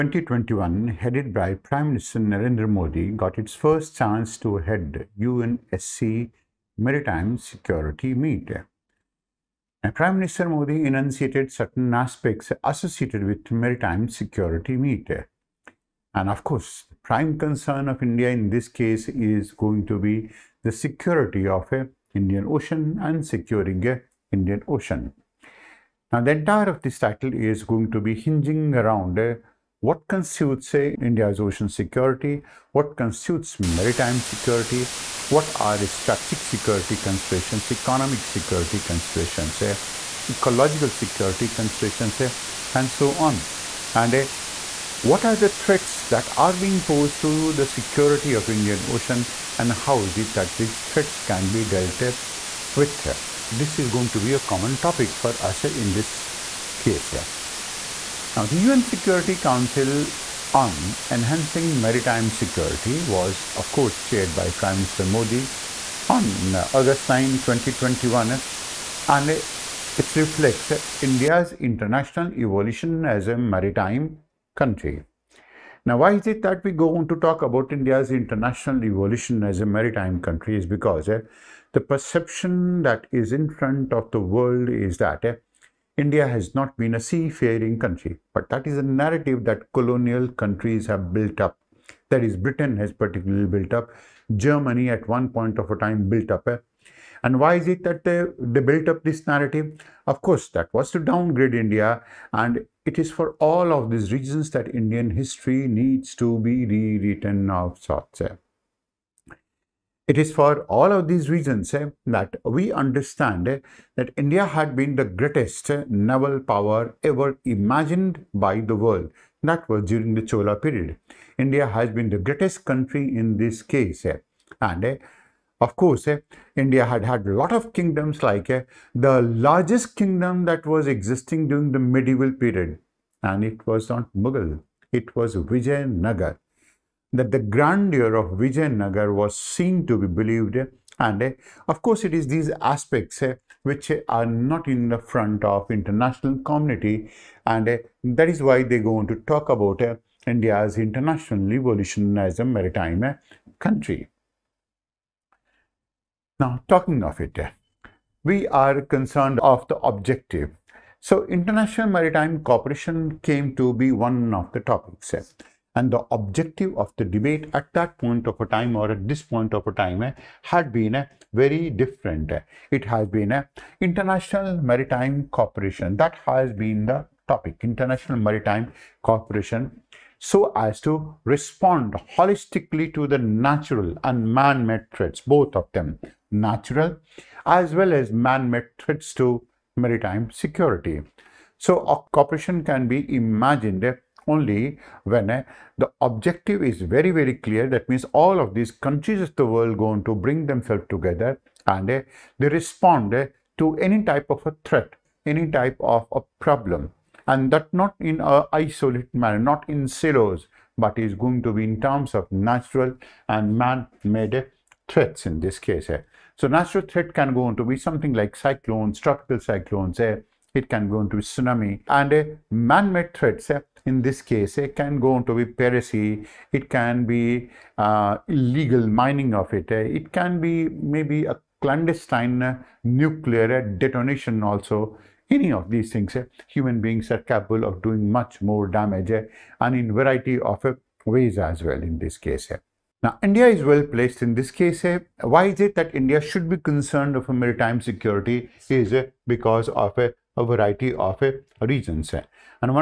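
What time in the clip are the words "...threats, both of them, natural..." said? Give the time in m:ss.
3:04.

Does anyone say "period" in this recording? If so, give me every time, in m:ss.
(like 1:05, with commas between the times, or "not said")
2:00, 2:12.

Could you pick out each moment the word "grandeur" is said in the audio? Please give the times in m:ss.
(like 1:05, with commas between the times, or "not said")
2:17.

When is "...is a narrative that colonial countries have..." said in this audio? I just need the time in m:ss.
1:28.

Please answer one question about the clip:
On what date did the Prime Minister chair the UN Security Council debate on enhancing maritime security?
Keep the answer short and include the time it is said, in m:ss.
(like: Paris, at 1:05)
August 9 2021, at 1:06.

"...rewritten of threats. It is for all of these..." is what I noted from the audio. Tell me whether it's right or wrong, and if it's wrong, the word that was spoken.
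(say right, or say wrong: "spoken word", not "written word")
wrong: "sorts", not "threats".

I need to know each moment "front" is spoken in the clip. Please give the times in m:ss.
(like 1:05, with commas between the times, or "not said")
1:23, 2:24.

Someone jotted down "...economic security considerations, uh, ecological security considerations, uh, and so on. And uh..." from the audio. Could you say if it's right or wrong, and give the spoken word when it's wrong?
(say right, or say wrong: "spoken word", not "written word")
right.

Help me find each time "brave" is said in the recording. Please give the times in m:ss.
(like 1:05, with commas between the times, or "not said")
not said.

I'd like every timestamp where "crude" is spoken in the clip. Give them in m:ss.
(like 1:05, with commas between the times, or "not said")
not said.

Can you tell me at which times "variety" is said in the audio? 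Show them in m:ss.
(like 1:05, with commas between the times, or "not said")
3:59, 4:10.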